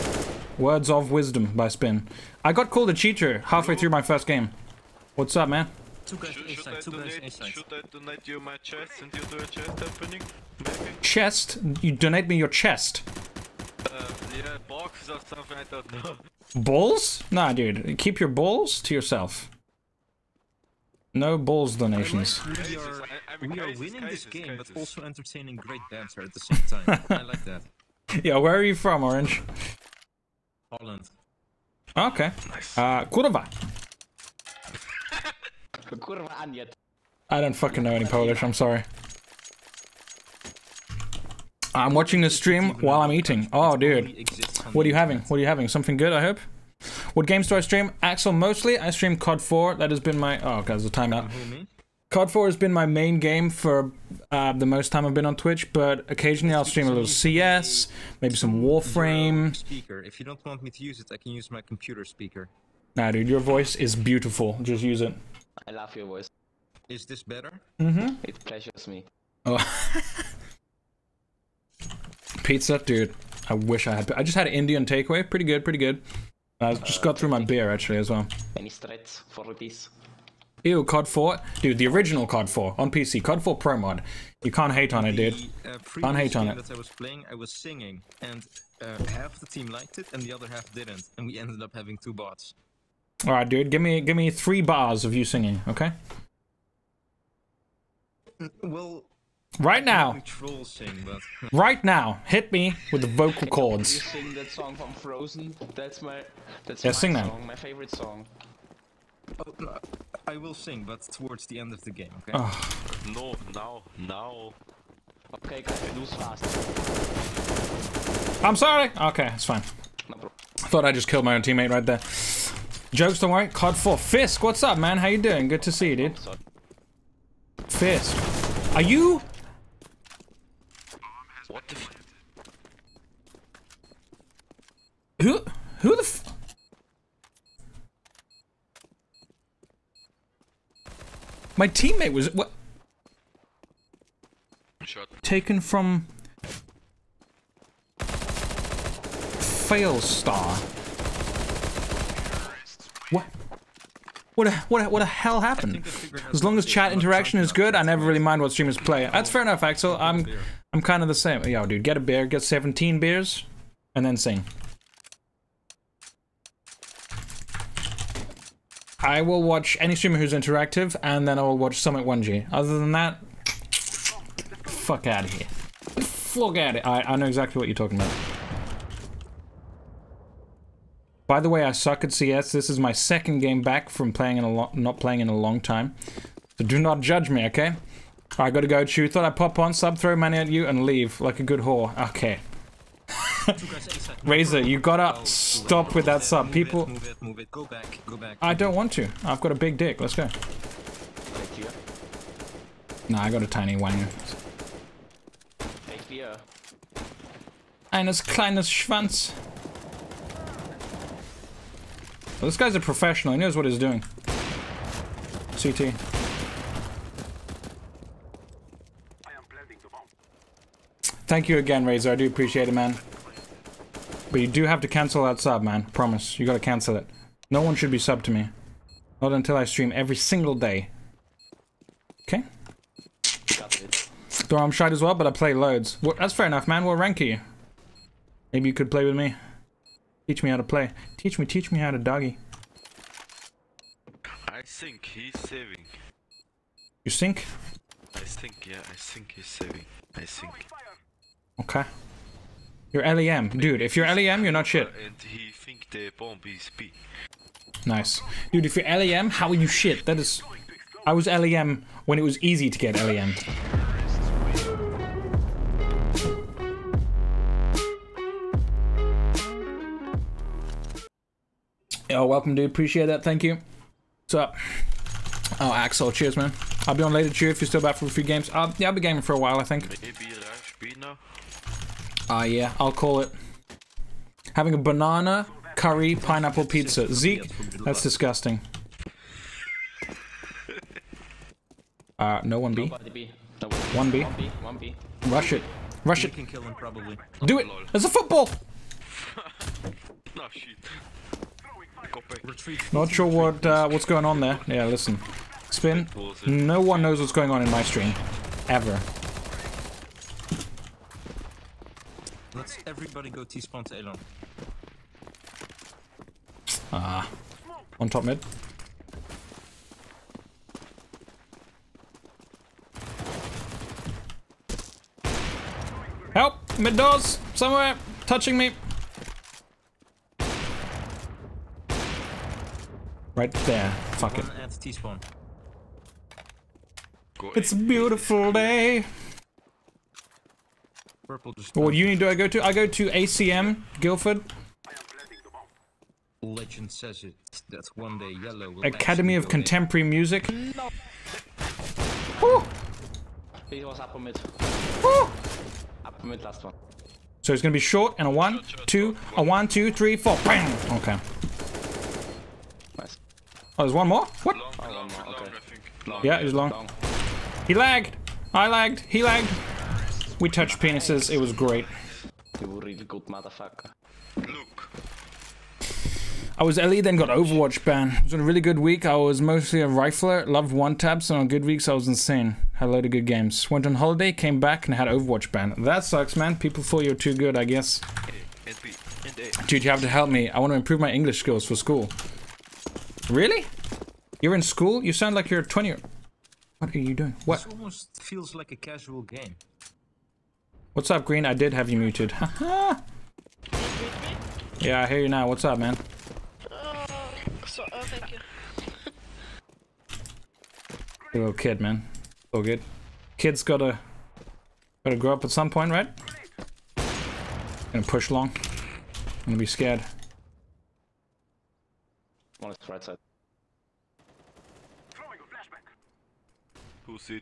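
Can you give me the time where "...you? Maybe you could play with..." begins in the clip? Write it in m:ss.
3:57.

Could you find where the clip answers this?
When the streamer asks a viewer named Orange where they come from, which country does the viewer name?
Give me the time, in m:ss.
0:30.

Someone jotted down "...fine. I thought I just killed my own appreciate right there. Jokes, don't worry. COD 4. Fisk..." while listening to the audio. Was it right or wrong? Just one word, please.
wrong.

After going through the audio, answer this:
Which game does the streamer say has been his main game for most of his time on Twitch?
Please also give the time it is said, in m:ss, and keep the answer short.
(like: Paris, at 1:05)
COD 4, at 0:52.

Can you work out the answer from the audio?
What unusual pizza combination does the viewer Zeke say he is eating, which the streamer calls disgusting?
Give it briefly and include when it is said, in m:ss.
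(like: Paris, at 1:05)
banana curry pineapple pizza, at 4:44.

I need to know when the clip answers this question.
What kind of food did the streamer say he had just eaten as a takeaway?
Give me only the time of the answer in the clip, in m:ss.
1:14.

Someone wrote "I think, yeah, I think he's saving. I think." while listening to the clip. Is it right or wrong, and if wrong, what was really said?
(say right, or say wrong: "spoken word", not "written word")
right.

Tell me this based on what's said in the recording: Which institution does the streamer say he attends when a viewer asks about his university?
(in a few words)
ACM Guildford.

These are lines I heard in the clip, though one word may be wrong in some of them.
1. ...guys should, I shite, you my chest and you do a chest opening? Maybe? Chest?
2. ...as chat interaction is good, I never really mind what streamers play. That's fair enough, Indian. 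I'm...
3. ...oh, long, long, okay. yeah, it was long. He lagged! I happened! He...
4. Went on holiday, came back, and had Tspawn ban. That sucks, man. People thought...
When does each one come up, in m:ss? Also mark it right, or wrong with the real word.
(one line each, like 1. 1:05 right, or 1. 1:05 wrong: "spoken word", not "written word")
1. 0:06 wrong: "donate", not "shite"
2. 2:36 wrong: "Axel", not "Indian"
3. 6:04 wrong: "lagged", not "happened"
4. 6:23 wrong: "Overwatch", not "Tspawn".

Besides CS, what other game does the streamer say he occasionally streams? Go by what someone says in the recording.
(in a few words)
Warframe.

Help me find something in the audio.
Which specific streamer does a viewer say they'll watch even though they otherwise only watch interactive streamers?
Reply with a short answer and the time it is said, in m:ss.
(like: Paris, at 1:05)
Summit 1G, at 2:51.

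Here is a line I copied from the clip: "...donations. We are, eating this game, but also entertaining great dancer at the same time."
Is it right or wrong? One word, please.
wrong.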